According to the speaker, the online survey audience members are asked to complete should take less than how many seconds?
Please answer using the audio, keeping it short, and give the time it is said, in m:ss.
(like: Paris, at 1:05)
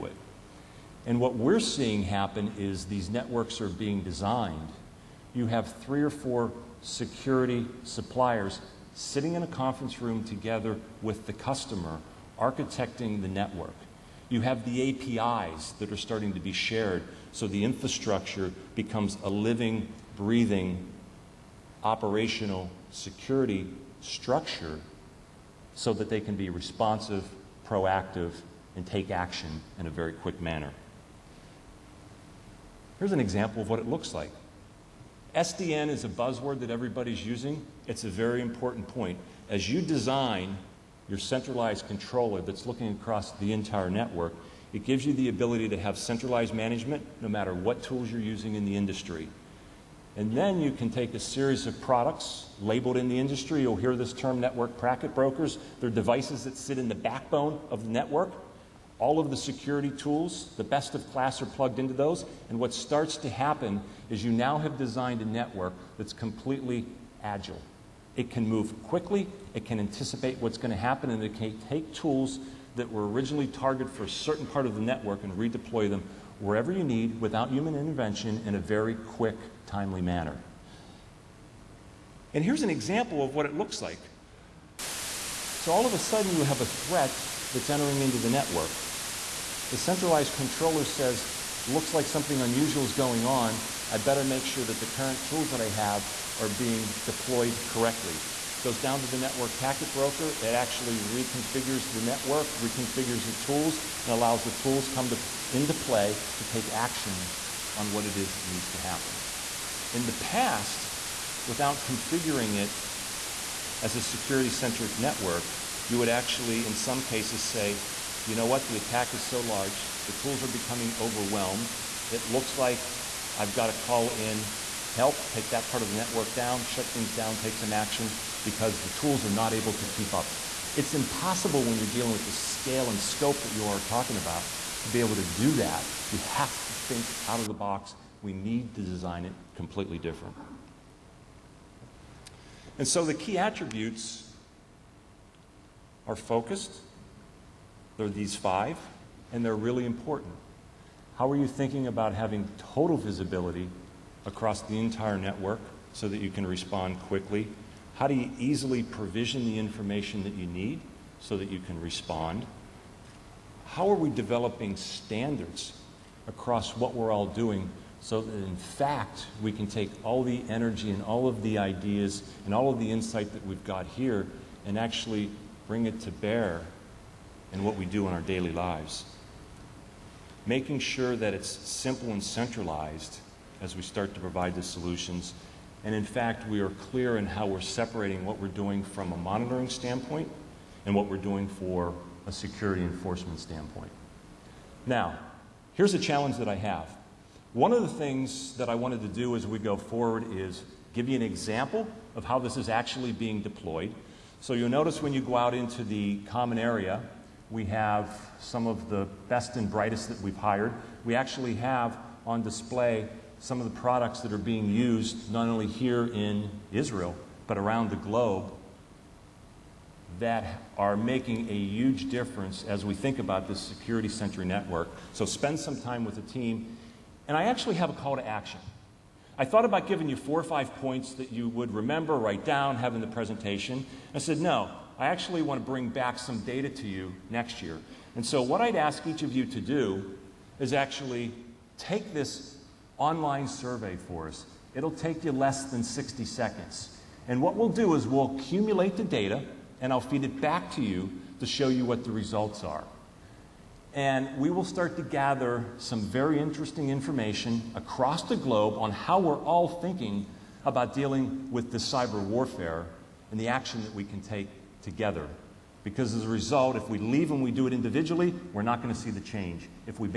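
60, at 4:05.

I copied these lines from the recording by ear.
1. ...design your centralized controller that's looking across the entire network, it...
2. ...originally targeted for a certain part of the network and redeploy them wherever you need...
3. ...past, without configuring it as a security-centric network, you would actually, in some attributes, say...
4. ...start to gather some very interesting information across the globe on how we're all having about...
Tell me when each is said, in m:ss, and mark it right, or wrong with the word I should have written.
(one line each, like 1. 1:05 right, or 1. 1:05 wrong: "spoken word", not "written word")
1. 0:39 right
2. 1:13 right
3. 1:50 wrong: "cases", not "attributes"
4. 4:14 wrong: "thinking", not "having".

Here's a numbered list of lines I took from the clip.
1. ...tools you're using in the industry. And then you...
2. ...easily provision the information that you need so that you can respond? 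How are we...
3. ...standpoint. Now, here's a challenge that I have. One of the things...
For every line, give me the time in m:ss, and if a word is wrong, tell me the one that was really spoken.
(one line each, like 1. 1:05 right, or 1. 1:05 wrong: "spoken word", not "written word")
1. 0:47 right
2. 2:38 right
3. 3:13 right.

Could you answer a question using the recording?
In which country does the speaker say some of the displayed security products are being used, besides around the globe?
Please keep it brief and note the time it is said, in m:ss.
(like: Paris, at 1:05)
Israel, at 3:36.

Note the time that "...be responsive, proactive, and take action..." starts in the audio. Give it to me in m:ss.
0:26.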